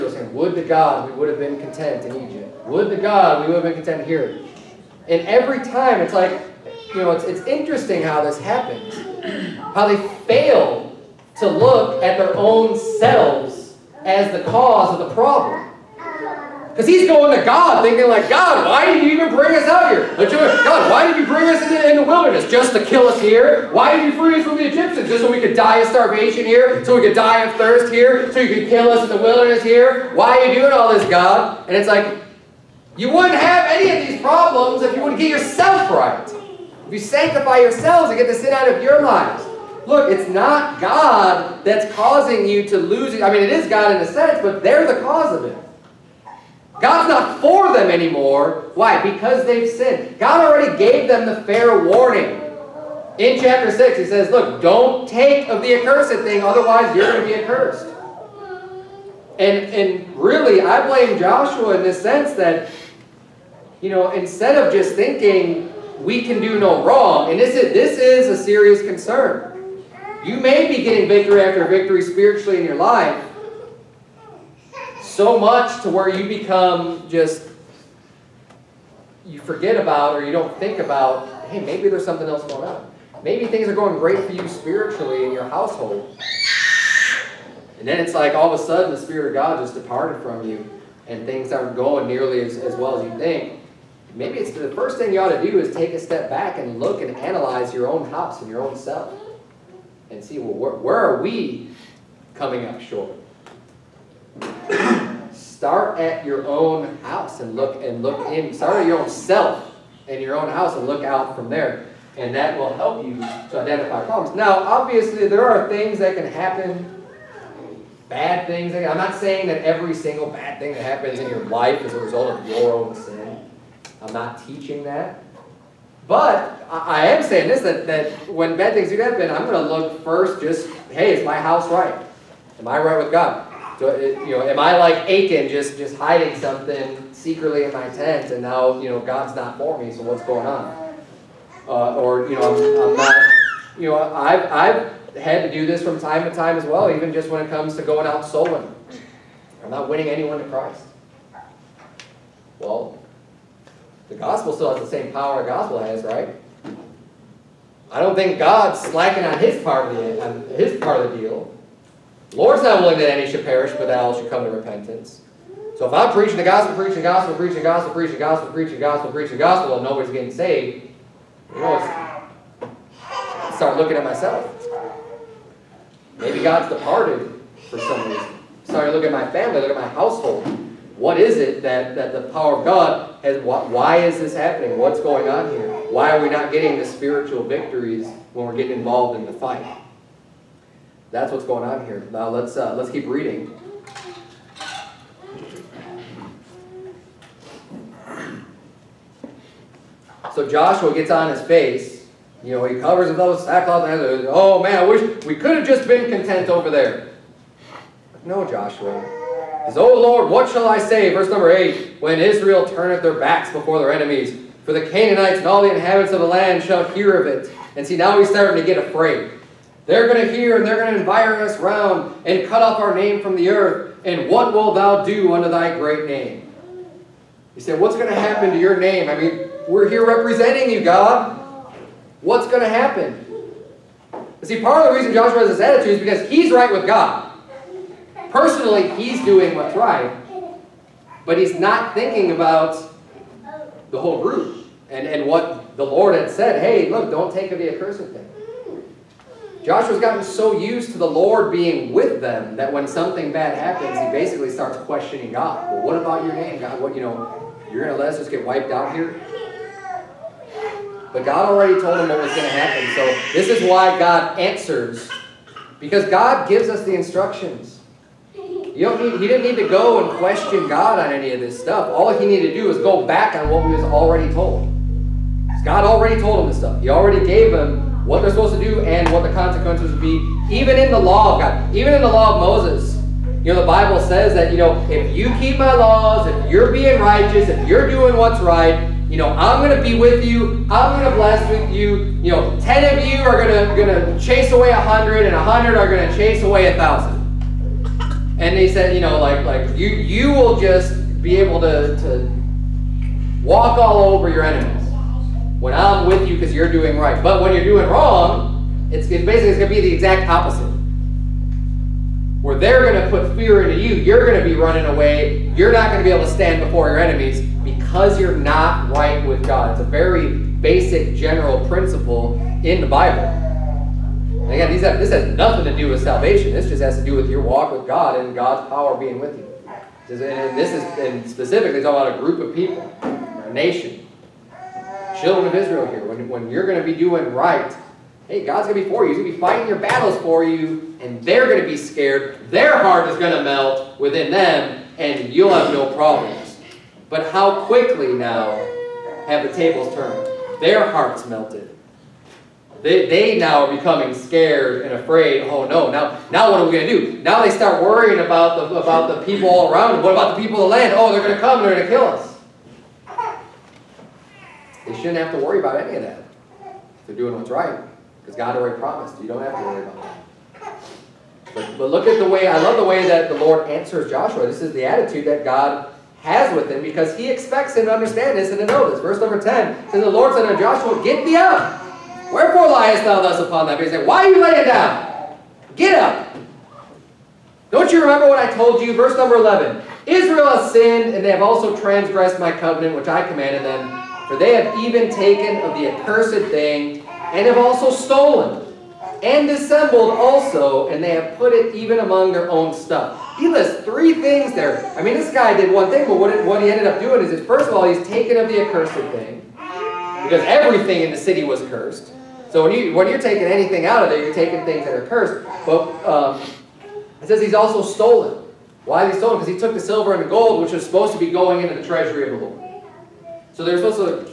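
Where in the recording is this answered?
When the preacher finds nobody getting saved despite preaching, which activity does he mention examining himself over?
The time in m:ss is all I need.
2:28.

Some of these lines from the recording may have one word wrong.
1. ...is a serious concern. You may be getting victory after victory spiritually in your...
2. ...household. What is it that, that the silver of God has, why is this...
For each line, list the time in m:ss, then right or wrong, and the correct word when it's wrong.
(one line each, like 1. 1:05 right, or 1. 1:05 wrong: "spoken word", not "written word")
1. 1:07 right
2. 2:59 wrong: "power", not "silver".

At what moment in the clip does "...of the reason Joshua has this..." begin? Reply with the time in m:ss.
3:54.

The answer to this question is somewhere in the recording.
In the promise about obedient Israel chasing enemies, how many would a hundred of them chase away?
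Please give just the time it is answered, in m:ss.
4:56.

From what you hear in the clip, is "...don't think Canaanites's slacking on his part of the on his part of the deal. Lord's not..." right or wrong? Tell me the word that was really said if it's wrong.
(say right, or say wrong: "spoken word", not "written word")
wrong: "God", not "Canaanites".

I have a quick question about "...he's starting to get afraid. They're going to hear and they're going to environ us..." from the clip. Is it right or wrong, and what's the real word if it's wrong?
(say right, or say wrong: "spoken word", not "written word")
right.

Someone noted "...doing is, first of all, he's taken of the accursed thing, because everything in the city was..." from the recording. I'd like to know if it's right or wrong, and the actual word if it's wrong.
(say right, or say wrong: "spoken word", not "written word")
right.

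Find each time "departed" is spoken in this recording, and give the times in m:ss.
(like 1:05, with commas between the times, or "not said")
1:29, 2:56.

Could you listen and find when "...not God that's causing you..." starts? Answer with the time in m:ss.
0:40.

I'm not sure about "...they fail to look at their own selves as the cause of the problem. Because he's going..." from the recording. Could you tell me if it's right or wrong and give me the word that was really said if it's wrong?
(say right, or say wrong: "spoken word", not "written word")
right.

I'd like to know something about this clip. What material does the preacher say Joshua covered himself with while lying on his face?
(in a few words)
Sackcloth.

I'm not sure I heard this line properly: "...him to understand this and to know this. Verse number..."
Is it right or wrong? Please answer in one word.
right.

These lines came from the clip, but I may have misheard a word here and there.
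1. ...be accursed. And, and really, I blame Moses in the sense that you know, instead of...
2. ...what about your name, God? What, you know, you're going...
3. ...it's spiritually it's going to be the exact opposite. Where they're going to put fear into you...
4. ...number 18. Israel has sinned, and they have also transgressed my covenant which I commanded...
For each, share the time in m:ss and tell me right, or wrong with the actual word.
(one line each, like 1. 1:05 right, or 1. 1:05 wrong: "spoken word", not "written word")
1. 0:57 wrong: "Joshua", not "Moses"
2. 4:15 right
3. 5:09 wrong: "basically", not "spiritually"
4. 6:29 wrong: "11", not "18".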